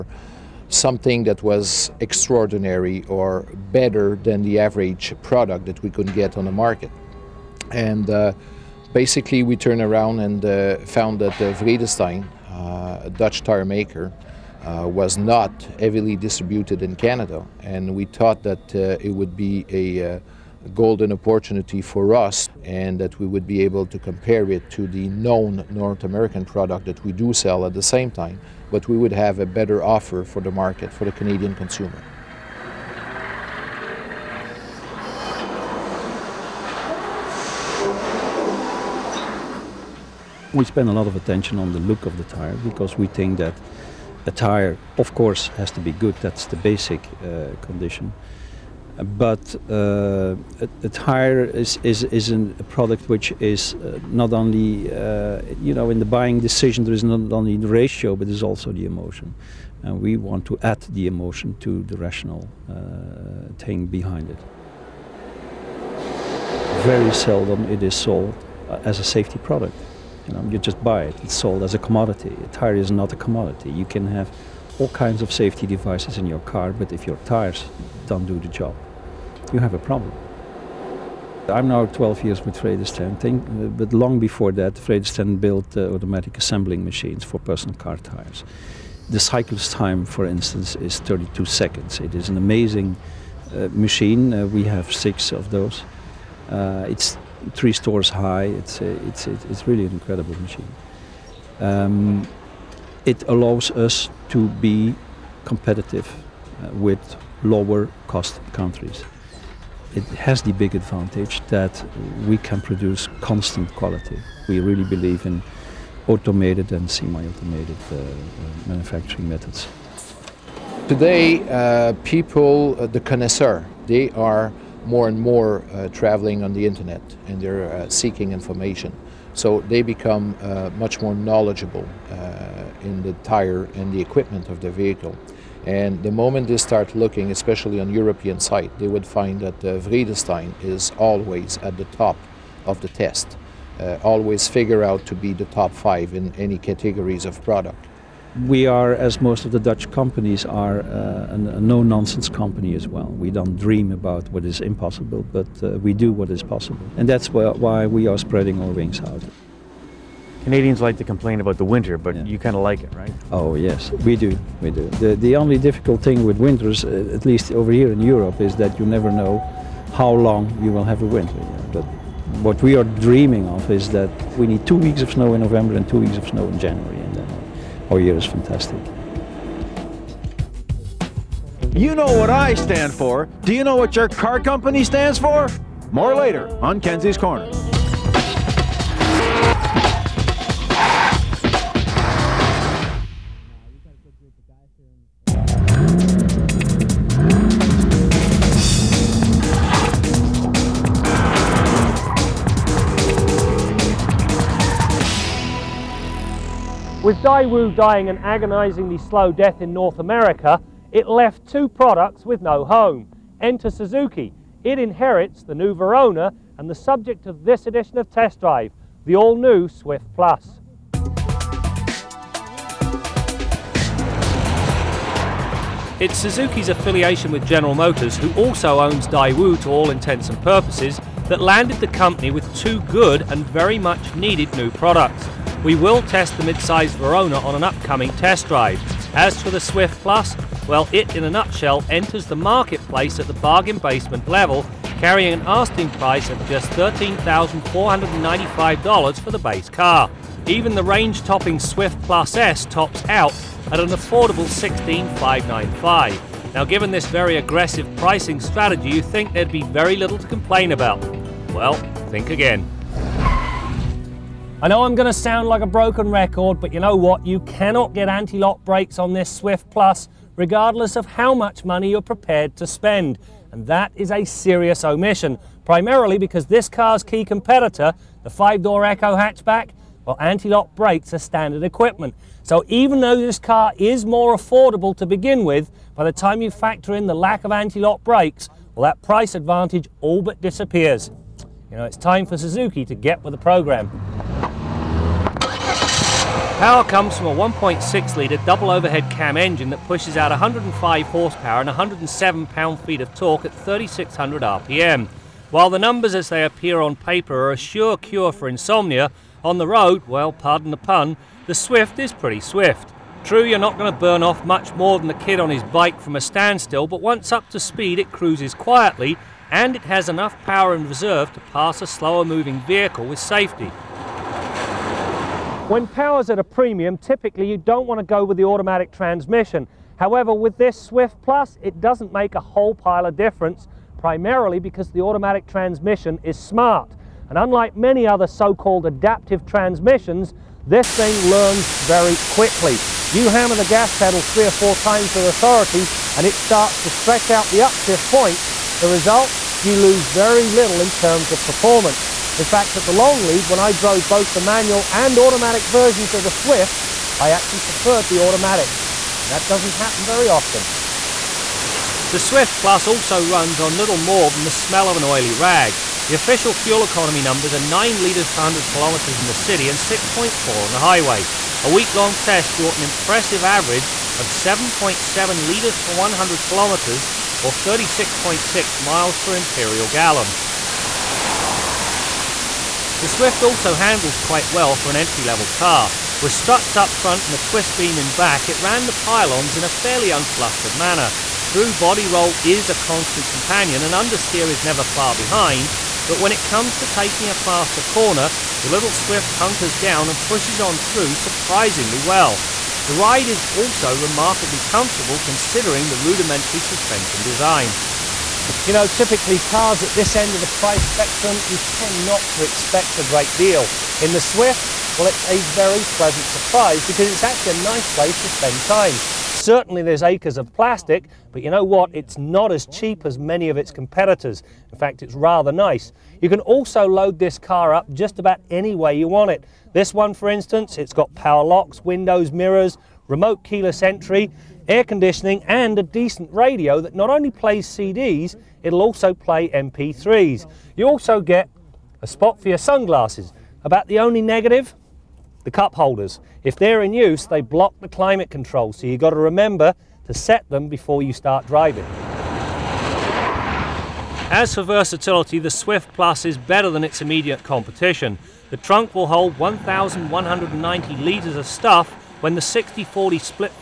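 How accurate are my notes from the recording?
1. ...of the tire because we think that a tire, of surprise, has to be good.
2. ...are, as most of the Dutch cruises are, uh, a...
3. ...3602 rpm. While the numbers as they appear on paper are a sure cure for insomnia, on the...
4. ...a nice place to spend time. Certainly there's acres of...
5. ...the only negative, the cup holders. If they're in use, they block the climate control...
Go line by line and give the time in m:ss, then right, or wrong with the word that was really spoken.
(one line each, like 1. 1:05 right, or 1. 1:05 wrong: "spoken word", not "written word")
1. 0:42 wrong: "course", not "surprise"
2. 2:28 wrong: "companies", not "cruises"
3. 5:03 wrong: "3600", not "3602"
4. 6:57 right
5. 7:23 right.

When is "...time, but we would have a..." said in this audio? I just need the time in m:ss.
0:28.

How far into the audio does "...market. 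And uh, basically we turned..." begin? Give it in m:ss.
0:06.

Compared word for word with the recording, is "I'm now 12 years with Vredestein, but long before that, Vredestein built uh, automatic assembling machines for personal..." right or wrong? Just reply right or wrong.
right.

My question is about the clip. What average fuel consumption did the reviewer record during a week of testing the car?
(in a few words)
7.7 litres per 100 km.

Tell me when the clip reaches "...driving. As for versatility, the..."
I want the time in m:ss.
7:31.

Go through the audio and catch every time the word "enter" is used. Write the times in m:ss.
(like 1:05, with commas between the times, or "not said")
3:33, 4:01.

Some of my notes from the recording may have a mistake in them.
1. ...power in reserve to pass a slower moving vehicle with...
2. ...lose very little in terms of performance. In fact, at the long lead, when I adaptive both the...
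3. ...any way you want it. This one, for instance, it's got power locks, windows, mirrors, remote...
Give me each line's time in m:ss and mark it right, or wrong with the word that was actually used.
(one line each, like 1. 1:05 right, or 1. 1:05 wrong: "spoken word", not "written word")
1. 5:20 right
2. 5:49 wrong: "drove", not "adaptive"
3. 7:08 right.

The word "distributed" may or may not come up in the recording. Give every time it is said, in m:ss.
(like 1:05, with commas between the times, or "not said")
0:16.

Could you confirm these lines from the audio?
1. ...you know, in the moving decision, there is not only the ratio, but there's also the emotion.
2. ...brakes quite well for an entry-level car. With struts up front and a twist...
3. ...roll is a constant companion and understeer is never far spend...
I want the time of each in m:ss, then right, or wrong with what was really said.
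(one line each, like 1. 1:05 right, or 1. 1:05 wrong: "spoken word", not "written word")
1. 0:55 wrong: "buying", not "moving"
2. 6:23 wrong: "handles", not "brakes"
3. 6:32 wrong: "behind", not "spend".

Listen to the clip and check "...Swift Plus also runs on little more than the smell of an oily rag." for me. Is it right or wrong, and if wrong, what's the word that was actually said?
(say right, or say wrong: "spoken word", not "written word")
right.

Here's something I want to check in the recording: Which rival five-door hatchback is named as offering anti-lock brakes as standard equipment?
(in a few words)
Echo.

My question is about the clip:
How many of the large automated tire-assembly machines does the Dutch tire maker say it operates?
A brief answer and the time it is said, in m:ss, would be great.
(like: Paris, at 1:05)
6, at 1:34.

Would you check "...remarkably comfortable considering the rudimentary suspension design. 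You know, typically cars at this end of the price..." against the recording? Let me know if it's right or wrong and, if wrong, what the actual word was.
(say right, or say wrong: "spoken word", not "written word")
right.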